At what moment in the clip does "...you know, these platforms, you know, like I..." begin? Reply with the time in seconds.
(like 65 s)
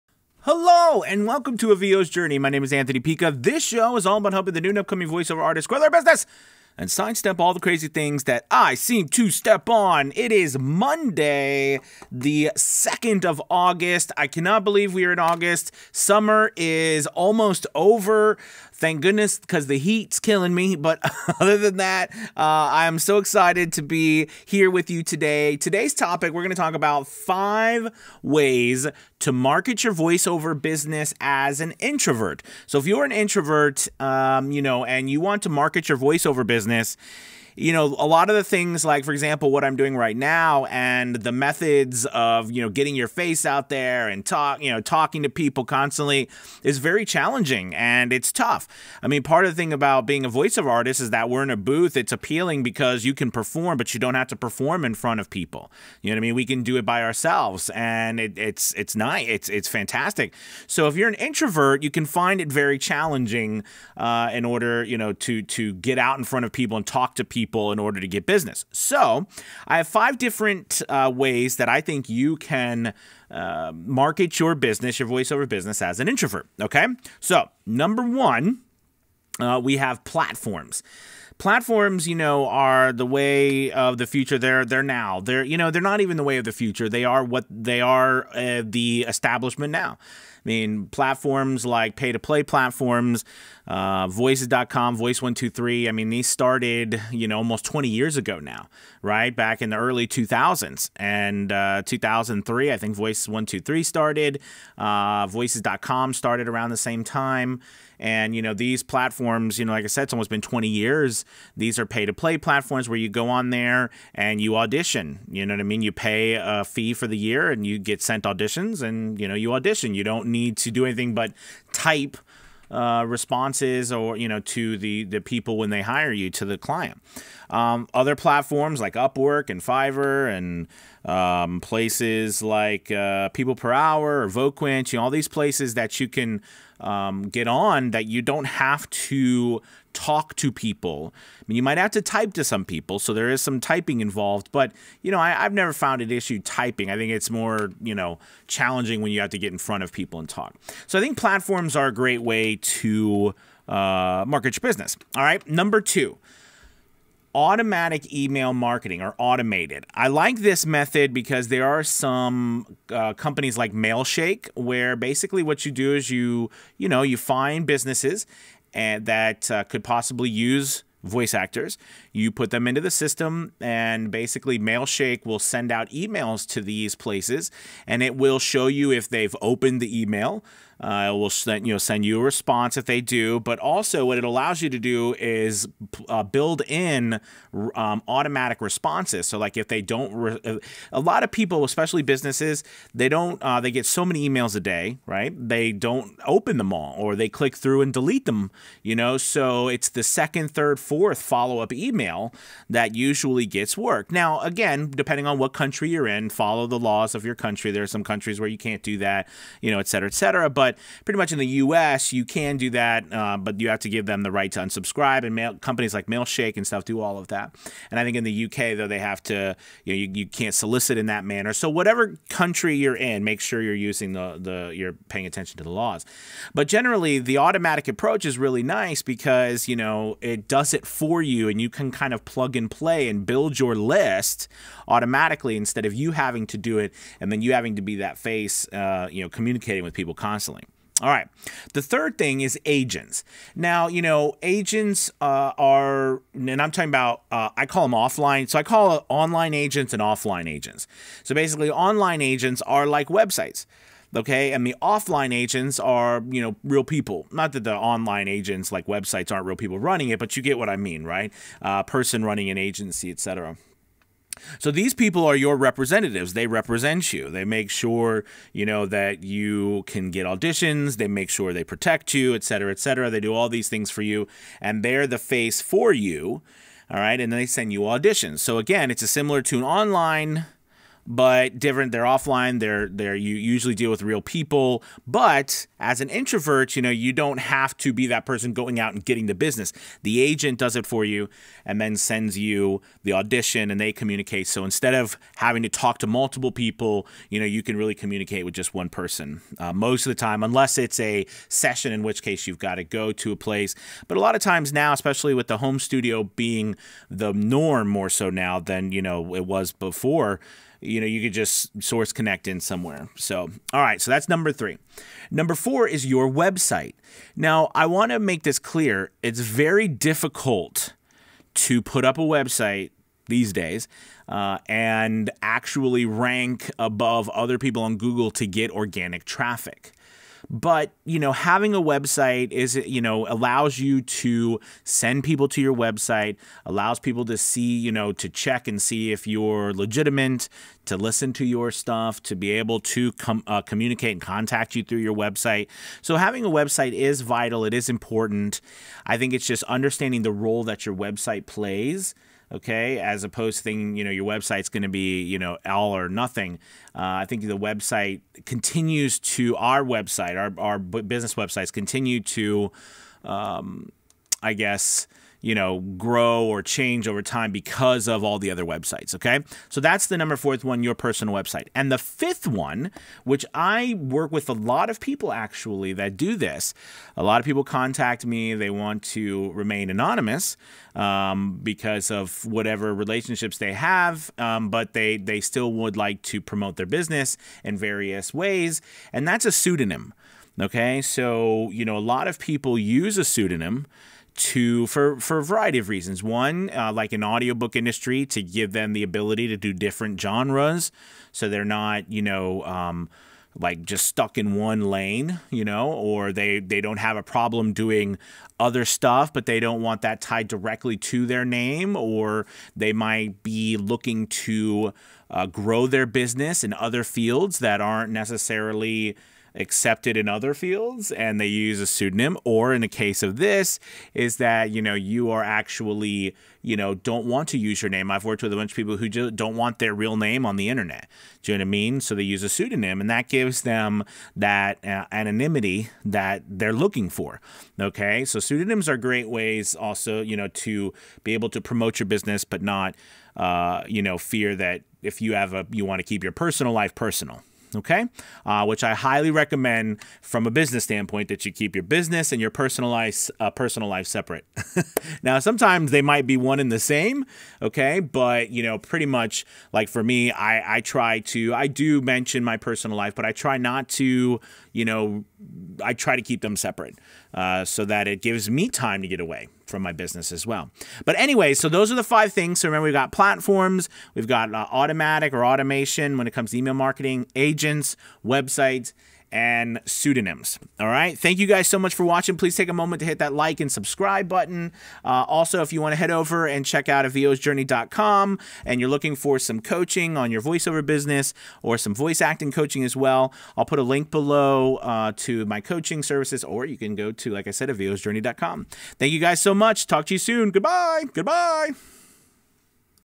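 108 s.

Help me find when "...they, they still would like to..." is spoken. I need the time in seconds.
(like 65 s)
384 s.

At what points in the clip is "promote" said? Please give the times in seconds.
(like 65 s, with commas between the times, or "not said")
386 s, 441 s.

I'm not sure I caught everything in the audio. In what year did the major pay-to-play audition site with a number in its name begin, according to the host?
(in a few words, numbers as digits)
2003.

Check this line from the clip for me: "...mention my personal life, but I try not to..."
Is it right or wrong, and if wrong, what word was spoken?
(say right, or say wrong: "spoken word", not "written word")
right.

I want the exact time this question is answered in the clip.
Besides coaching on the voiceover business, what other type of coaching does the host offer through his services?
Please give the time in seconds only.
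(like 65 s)
491 s.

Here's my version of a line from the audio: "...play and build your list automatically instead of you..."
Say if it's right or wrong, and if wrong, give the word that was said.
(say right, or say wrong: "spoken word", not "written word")
right.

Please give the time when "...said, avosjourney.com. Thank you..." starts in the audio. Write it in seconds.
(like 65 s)
497 s.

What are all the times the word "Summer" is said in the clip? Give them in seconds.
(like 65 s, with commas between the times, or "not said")
15 s.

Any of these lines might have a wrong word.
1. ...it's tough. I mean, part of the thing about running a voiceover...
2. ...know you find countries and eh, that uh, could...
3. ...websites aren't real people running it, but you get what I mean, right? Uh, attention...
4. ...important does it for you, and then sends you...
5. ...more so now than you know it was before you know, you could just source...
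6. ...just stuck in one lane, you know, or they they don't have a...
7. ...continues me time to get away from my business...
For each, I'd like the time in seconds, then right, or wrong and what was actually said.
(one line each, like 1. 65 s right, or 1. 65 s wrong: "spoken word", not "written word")
1. 48 s wrong: "being", not "running"
2. 166 s wrong: "businesses", not "countries"
3. 258 s wrong: "person", not "attention"
4. 290 s wrong: "agent", not "important"
5. 307 s right
6. 403 s right
7. 468 s wrong: "gives", not "continues".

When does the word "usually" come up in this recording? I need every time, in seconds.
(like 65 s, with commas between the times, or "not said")
202 s, 283 s.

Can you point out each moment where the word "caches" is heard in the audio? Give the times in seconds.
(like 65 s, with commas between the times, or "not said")
not said.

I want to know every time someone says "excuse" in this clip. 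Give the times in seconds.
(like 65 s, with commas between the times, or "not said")
not said.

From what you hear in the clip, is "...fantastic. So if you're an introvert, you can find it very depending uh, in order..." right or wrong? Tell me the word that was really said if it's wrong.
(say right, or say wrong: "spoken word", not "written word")
wrong: "challenging", not "depending".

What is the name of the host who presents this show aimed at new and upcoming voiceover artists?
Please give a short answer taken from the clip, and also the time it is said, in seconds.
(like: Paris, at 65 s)
Anthony Pica, at 2 s.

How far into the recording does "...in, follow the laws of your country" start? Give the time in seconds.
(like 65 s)
206 s.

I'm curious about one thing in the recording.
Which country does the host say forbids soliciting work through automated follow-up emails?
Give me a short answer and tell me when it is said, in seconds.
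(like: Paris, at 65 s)
U.K., at 218 s.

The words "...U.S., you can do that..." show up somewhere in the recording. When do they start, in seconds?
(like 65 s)
211 s.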